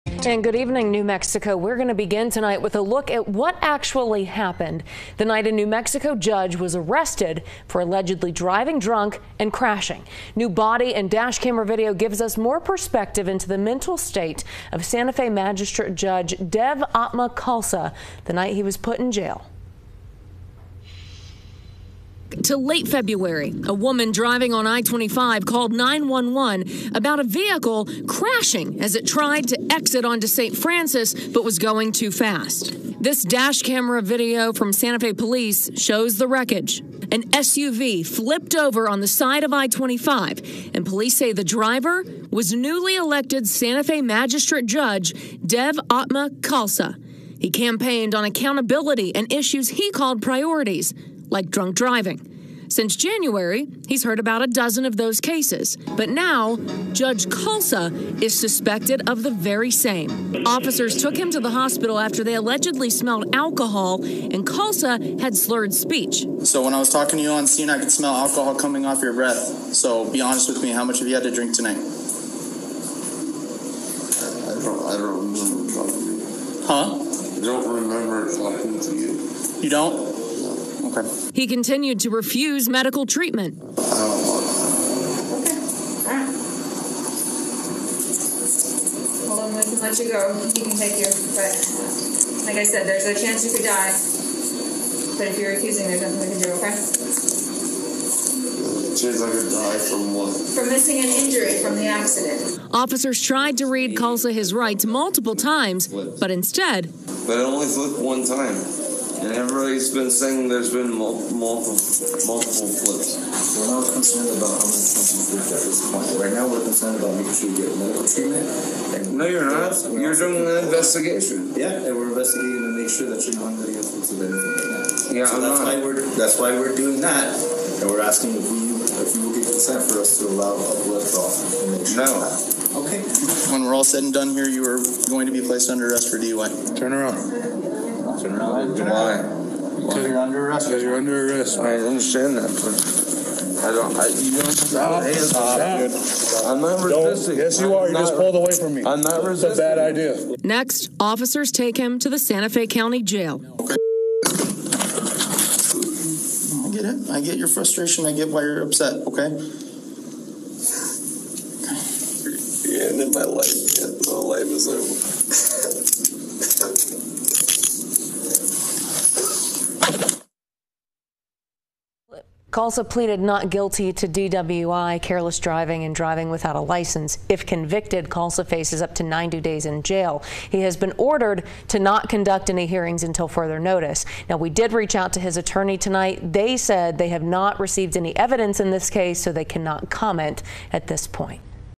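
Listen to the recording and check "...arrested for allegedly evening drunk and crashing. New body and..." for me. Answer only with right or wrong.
wrong.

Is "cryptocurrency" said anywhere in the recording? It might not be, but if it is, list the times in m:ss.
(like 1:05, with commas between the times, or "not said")
not said.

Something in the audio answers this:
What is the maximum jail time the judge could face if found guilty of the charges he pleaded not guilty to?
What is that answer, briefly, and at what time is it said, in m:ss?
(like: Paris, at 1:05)
90 days, at 2:59.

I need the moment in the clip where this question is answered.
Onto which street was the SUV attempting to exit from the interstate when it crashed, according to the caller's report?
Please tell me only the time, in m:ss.
0:30.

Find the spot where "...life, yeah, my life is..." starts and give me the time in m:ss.
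2:43.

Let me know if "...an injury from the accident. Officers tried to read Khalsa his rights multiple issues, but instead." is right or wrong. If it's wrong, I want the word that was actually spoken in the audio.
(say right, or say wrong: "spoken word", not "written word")
wrong: "times", not "issues".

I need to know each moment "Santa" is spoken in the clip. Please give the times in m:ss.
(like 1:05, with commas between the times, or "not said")
0:14, 0:34, 0:43, 2:32.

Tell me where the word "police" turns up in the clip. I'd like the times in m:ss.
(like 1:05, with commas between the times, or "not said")
0:35, 0:40.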